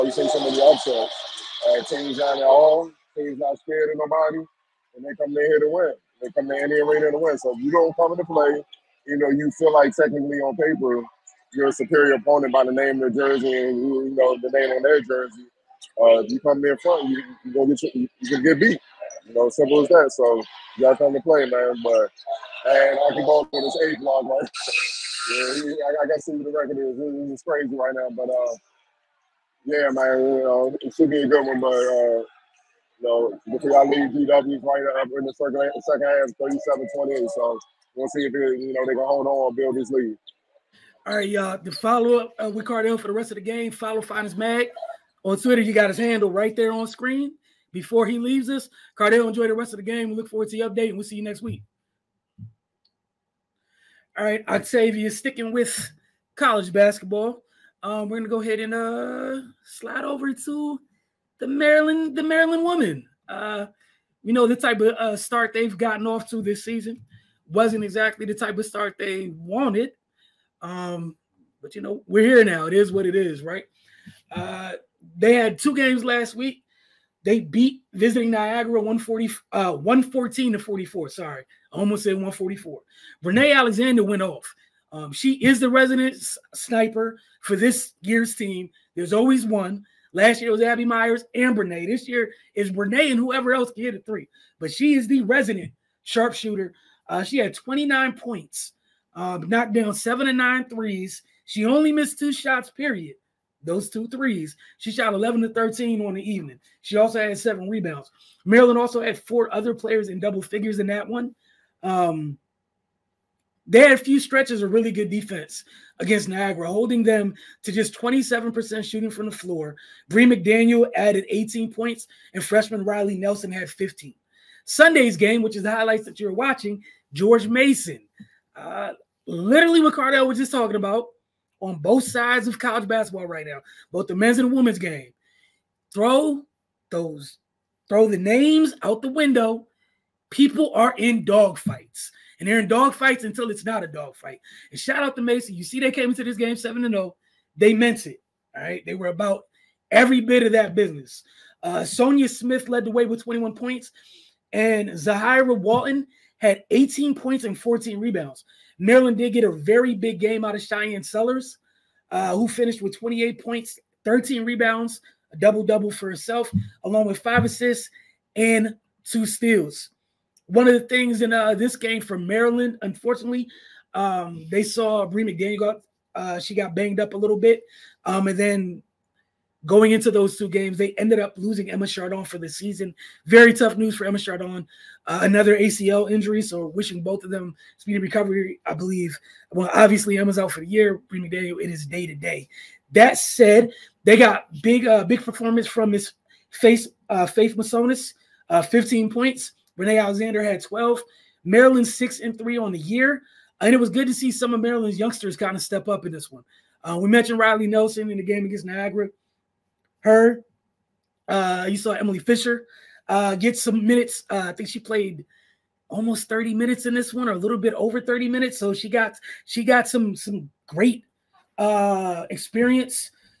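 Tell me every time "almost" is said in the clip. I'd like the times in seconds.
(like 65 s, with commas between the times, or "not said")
81 s, 215 s.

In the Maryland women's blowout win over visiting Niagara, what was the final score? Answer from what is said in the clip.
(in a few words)
114-44.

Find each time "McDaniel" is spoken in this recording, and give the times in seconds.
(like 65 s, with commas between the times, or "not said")
120 s, 175 s.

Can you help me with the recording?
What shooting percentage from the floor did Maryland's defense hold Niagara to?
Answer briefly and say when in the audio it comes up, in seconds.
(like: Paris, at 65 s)
27%, at 117 s.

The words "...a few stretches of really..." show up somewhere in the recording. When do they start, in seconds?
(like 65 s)
113 s.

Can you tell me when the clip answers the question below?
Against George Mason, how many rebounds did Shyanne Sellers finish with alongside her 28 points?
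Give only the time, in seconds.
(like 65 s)
164 s.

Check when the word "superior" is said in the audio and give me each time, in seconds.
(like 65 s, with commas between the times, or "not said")
11 s.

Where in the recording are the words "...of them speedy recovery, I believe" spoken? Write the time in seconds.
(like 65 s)
187 s.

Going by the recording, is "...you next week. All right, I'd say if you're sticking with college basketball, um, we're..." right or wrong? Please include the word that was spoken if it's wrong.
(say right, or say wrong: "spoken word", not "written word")
right.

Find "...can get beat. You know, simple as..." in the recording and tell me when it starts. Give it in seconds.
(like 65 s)
18 s.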